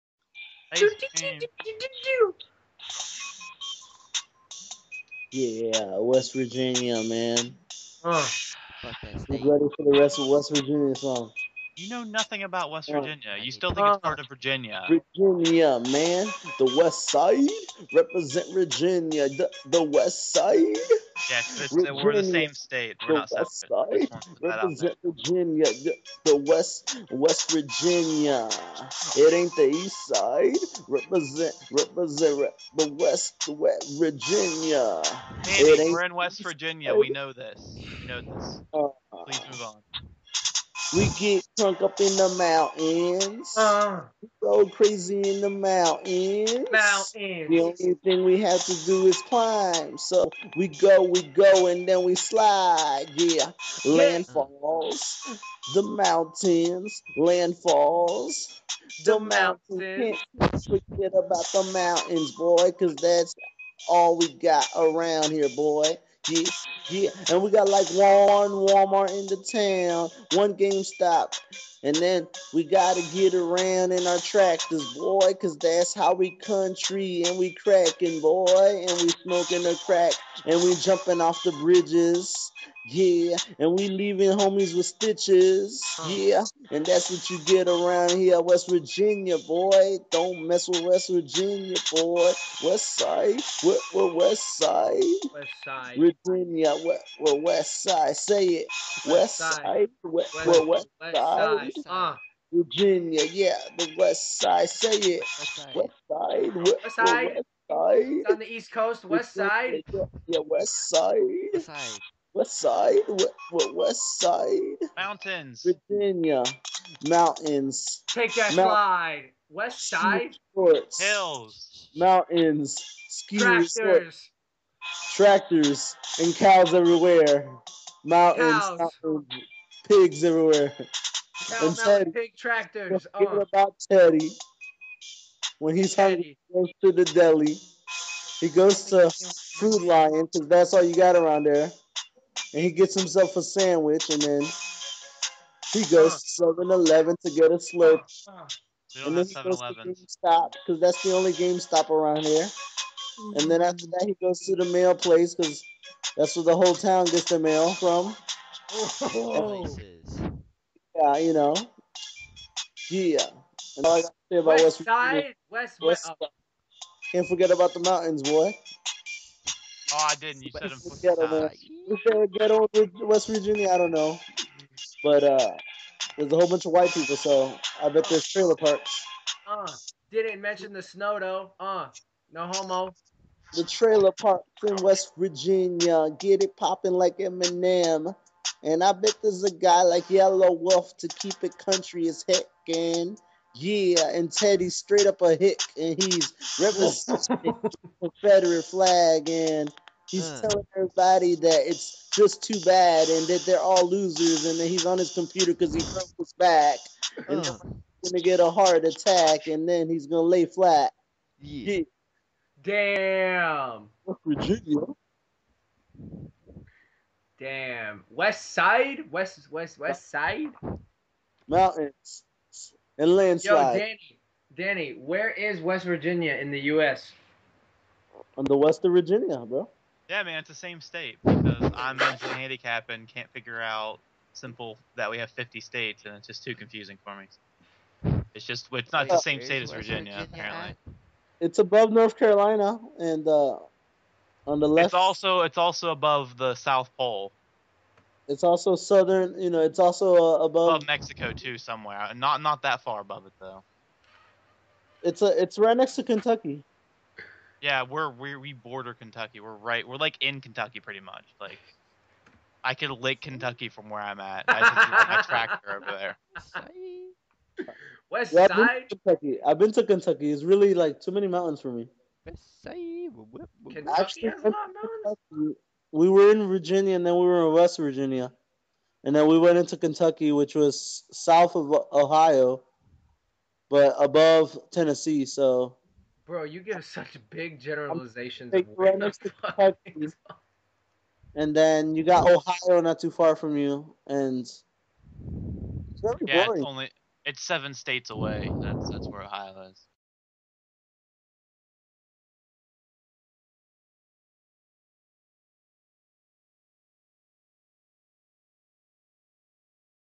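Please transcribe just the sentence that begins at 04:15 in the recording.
It's a it's right next to Kentucky.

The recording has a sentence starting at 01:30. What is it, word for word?
Don't mess with West Virginia, boy.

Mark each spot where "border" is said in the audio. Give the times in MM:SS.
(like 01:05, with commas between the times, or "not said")
04:18.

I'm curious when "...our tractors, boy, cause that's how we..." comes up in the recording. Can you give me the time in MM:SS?
01:14.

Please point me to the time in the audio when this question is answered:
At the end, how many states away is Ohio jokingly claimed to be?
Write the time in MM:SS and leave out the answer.
04:57.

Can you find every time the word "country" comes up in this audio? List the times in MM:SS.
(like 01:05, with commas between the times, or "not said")
01:16, 03:11.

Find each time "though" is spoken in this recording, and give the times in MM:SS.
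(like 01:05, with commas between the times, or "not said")
03:01, 04:13.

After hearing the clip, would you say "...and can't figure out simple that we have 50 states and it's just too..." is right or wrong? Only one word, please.
right.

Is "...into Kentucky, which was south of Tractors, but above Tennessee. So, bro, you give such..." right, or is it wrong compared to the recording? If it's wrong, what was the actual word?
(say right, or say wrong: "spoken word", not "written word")
wrong: "Ohio", not "Tractors".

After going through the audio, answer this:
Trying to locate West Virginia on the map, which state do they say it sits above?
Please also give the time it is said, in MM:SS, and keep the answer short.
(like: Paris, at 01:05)
North Carolina, at 04:01.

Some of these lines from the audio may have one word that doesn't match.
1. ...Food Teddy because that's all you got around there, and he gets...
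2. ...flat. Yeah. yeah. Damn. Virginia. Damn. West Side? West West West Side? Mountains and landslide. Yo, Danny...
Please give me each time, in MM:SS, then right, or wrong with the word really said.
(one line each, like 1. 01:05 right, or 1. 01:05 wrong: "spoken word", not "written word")
1. 02:19 wrong: "Lion", not "Teddy"
2. 03:30 right.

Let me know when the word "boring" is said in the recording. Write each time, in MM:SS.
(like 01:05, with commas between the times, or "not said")
04:56.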